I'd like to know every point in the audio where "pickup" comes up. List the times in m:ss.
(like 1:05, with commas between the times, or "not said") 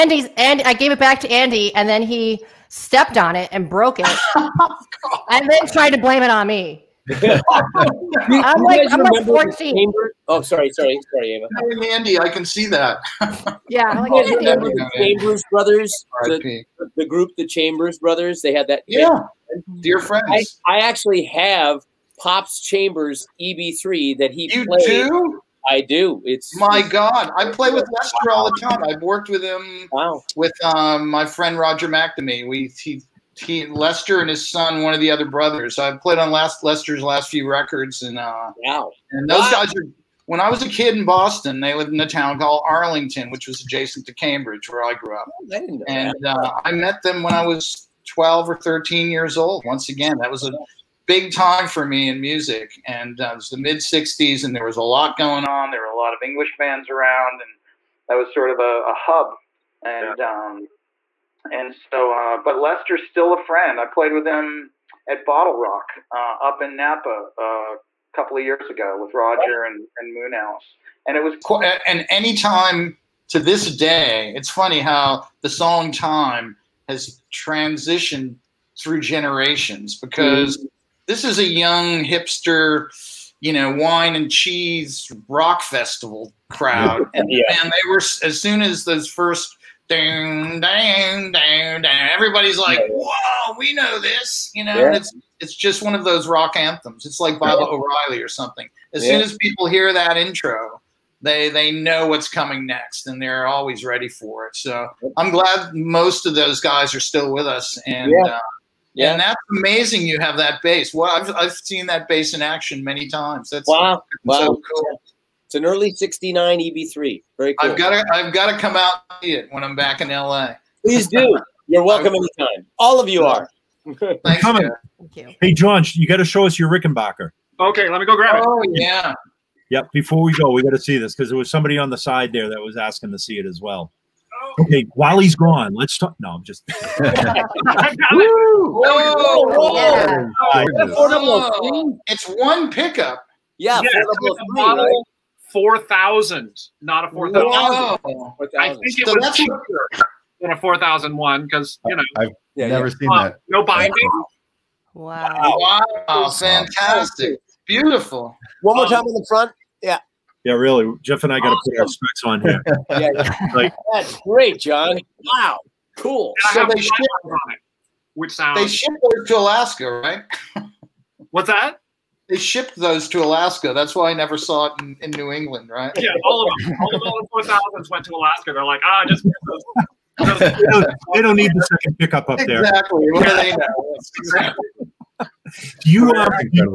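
2:22, 3:01.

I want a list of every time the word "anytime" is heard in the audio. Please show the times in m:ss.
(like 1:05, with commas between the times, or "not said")
1:12, 2:02.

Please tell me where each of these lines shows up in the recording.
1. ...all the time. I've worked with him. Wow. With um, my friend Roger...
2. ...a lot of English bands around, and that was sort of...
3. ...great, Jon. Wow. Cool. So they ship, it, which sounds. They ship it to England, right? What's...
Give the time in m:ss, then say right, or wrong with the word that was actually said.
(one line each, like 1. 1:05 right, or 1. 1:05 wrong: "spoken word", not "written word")
1. 0:28 right
2. 0:55 right
3. 2:44 wrong: "Alaska", not "England".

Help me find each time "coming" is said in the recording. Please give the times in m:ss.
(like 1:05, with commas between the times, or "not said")
1:42, 2:04.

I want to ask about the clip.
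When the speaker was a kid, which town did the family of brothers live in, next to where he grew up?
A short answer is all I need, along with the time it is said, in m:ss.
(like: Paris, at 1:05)
Arlington, at 0:42.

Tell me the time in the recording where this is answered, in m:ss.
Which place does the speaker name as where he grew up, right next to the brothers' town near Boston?
0:44.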